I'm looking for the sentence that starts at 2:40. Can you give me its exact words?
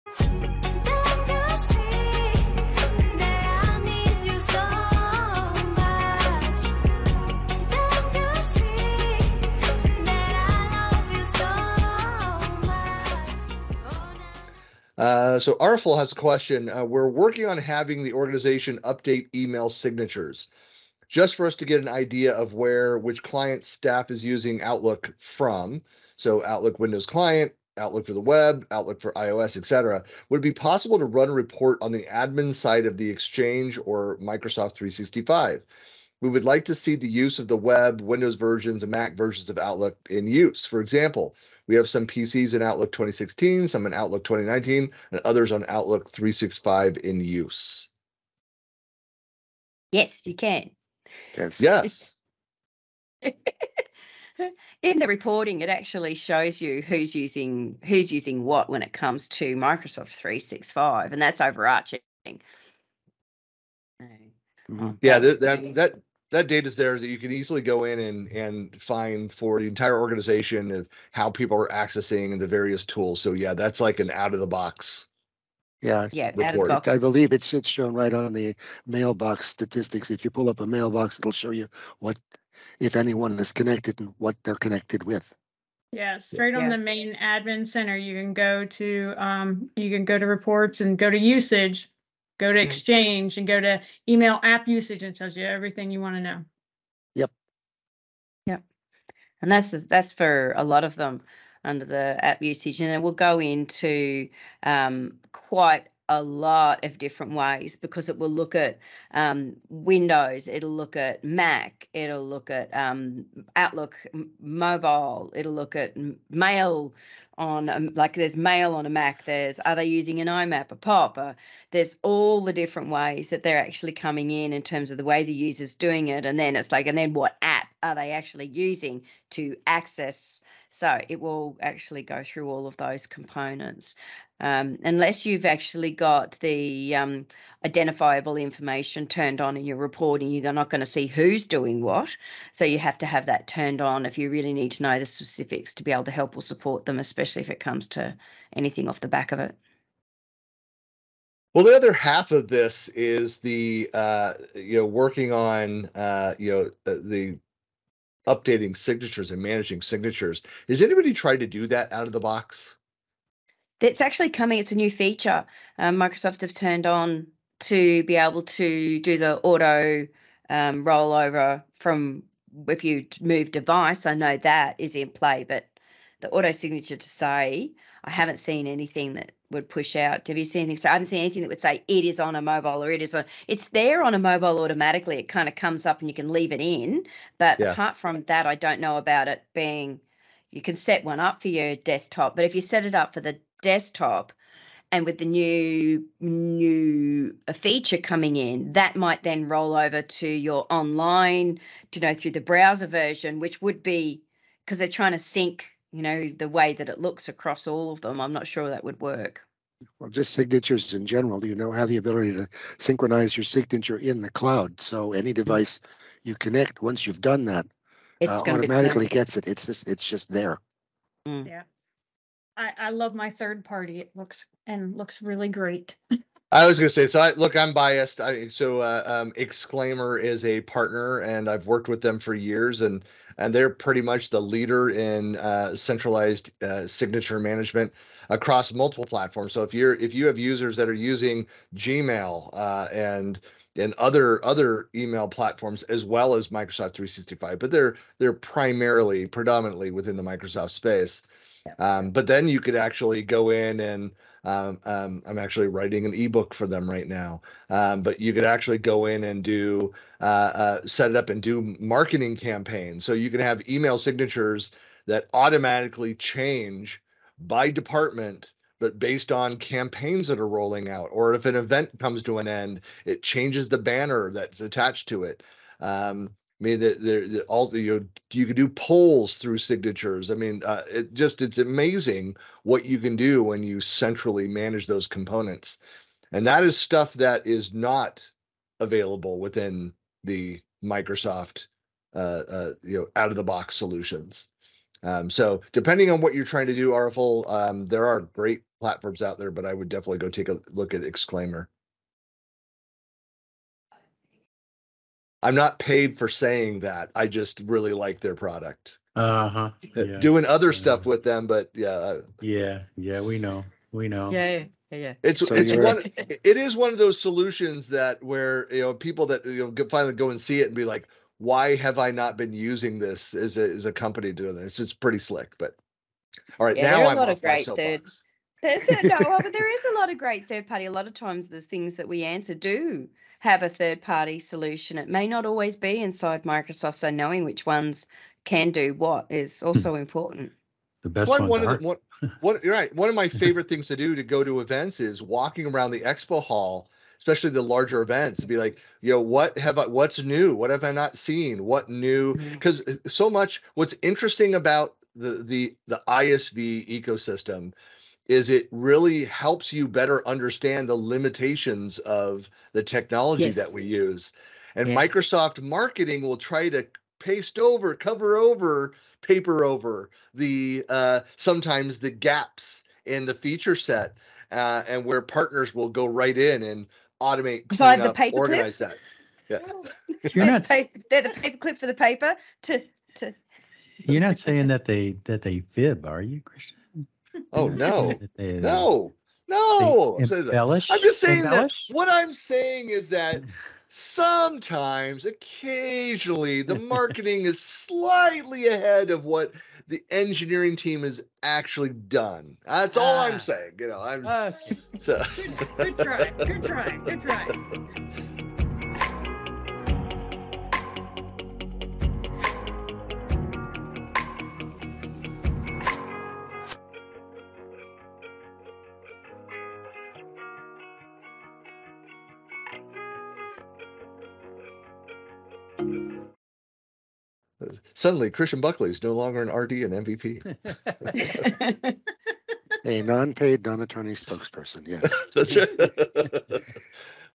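Has anybody tried to do that out of the box?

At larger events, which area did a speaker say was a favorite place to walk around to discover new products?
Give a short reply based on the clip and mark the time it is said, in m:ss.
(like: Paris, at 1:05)
the expo hall, at 5:46.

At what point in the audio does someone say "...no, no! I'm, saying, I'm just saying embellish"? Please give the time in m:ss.
6:28.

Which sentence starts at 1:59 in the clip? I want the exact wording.
There's are they using an IMAP, a POP?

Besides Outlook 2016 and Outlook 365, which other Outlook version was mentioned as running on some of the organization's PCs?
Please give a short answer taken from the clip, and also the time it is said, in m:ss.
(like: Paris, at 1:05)
Outlook 2019, at 0:43.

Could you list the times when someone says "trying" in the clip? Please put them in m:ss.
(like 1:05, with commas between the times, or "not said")
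3:24, 4:56.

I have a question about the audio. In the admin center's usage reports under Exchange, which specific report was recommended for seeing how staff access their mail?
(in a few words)
email app usage.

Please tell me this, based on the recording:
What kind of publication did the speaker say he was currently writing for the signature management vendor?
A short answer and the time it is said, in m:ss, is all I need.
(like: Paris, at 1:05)
an ebook, at 4:16.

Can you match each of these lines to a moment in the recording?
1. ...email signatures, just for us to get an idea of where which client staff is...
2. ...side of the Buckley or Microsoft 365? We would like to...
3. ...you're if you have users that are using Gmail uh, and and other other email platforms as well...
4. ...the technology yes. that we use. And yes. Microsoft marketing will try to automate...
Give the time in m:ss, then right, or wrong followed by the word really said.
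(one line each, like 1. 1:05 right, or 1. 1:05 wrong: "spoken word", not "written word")
1. 0:19 right
2. 0:32 wrong: "Exchange", not "Buckley"
3. 3:59 right
4. 6:02 wrong: "paste", not "automate".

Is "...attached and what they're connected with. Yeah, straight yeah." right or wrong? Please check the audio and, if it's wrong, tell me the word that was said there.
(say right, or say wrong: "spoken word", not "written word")
wrong: "connected", not "attached".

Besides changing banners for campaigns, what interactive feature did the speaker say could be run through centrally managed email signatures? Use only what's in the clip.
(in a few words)
polls.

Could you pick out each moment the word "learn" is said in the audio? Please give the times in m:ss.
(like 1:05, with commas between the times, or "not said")
not said.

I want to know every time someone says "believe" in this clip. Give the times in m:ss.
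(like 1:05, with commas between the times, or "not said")
1:16.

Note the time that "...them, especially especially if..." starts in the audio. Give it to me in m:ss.
2:26.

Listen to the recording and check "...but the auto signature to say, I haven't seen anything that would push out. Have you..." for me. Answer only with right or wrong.
right.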